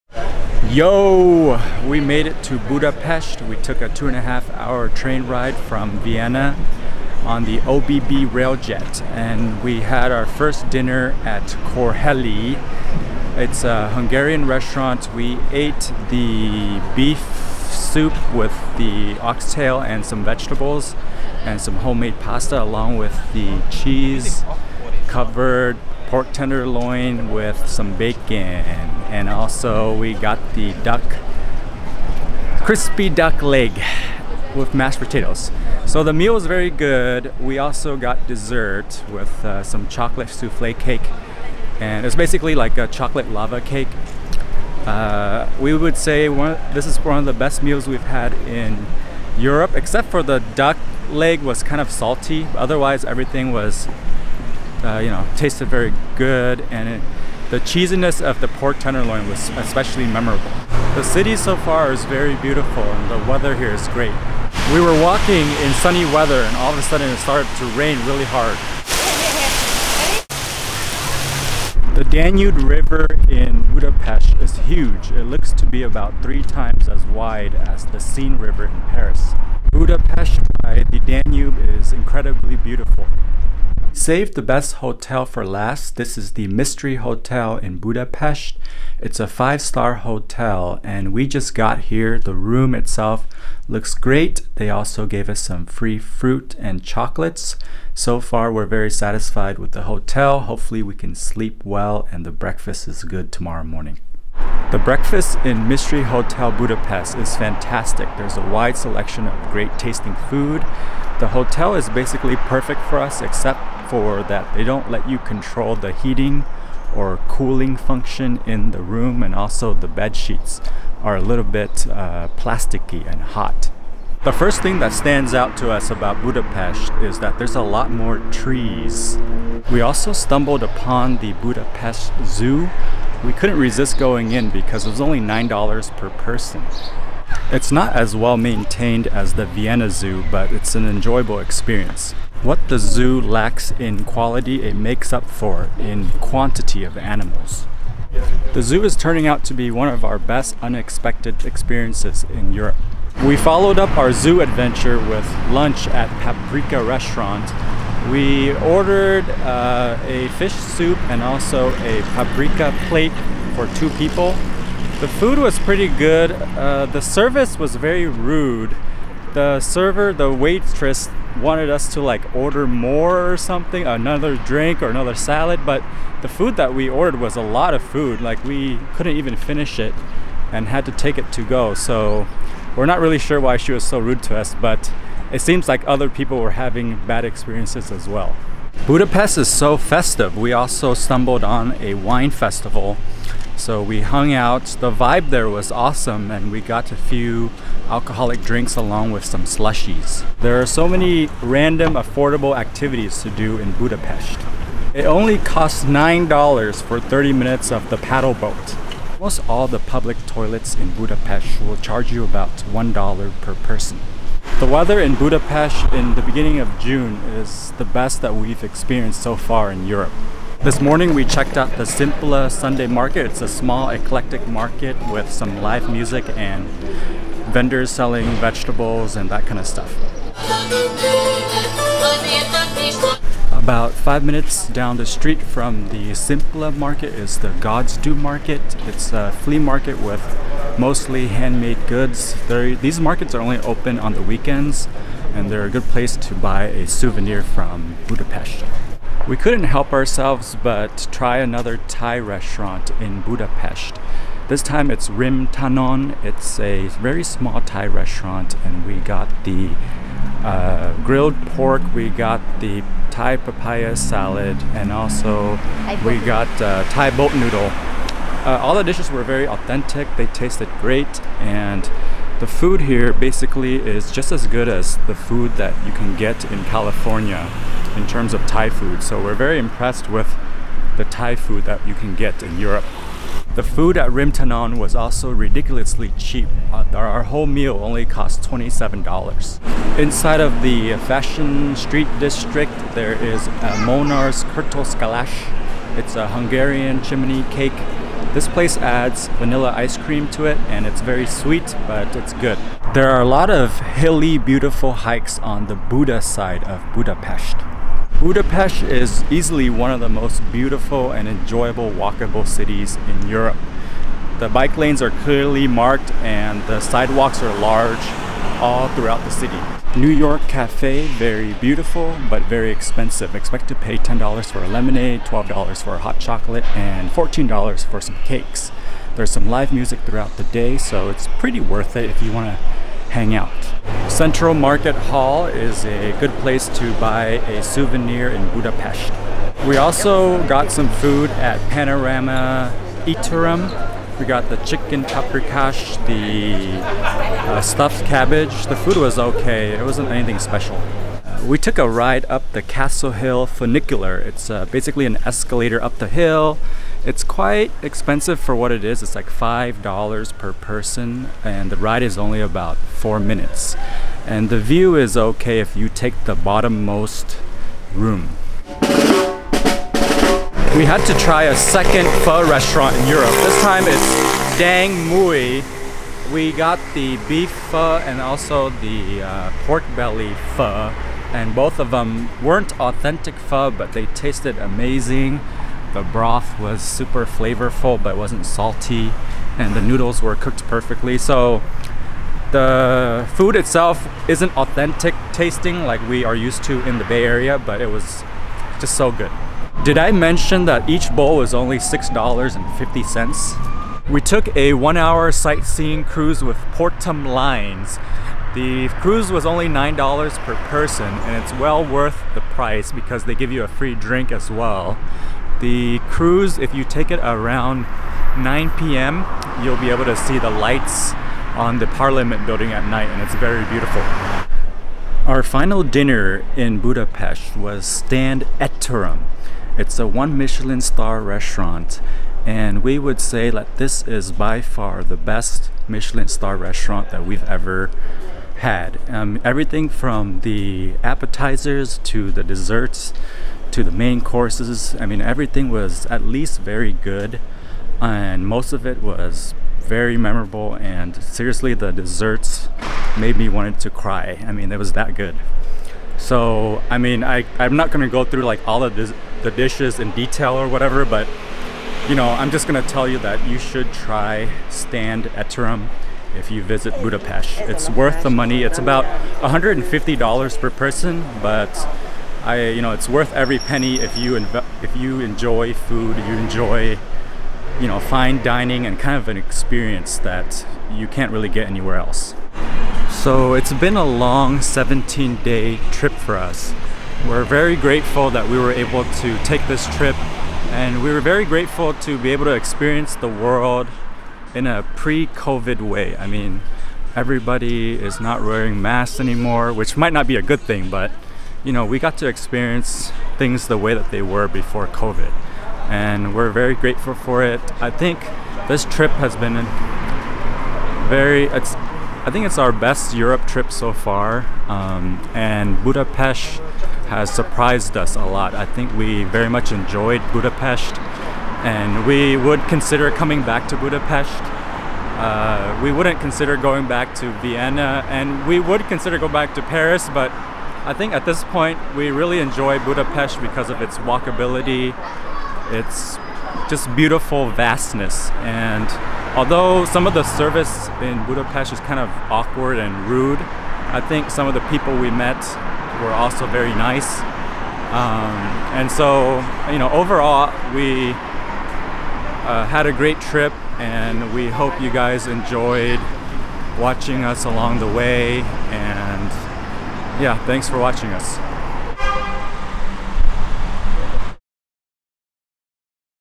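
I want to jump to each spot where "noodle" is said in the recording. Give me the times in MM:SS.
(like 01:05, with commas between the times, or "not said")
04:27, 06:29.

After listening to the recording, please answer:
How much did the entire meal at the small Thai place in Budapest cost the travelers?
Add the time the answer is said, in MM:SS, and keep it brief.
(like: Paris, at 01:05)
$27, at 04:48.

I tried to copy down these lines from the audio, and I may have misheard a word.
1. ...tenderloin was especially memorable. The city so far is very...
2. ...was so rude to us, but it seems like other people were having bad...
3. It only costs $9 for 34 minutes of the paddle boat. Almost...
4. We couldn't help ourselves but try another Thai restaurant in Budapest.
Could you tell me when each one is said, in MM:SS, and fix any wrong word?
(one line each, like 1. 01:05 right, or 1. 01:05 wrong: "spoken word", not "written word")
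1. 00:58 right
2. 03:03 right
3. 03:24 wrong: "30", not "34"
4. 04:09 right.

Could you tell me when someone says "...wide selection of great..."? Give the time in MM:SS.
01:48.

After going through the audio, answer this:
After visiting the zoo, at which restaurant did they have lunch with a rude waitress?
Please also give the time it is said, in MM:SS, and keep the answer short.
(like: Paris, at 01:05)
Paprika Restaurant, at 02:36.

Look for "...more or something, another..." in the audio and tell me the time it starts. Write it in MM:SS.
02:52.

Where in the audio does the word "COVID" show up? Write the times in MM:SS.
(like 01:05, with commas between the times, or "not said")
08:14, 08:24.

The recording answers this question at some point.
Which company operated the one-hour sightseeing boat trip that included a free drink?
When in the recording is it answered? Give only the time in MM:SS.
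06:46.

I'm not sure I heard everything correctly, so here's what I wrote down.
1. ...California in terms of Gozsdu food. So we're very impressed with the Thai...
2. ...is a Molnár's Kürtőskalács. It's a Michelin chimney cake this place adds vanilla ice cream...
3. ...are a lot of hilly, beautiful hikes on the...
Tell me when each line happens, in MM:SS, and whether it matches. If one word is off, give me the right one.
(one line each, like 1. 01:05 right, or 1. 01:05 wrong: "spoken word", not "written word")
1. 04:36 wrong: "Thai", not "Gozsdu"
2. 04:53 wrong: "Hungarian", not "Michelin"
3. 05:03 right.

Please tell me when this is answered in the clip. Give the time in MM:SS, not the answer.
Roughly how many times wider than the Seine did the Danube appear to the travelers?
01:16.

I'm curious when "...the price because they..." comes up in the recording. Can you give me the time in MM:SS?
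06:52.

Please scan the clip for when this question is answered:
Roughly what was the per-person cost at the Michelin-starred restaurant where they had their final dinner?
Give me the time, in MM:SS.
07:49.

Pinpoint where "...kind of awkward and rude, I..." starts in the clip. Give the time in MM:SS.
09:01.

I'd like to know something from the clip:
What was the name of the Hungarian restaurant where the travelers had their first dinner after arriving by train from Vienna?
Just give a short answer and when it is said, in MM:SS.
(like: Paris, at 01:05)
Korhely, at 00:11.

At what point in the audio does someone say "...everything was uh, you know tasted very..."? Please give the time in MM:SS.
00:53.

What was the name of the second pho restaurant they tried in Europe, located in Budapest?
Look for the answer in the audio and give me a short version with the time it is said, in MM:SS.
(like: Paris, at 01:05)
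Dang Muoi, at 06:14.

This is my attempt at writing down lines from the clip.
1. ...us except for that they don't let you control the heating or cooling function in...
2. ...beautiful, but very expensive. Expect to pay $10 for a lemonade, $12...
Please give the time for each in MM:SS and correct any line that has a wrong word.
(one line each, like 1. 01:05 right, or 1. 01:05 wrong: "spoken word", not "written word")
1. 01:52 right
2. 05:21 right.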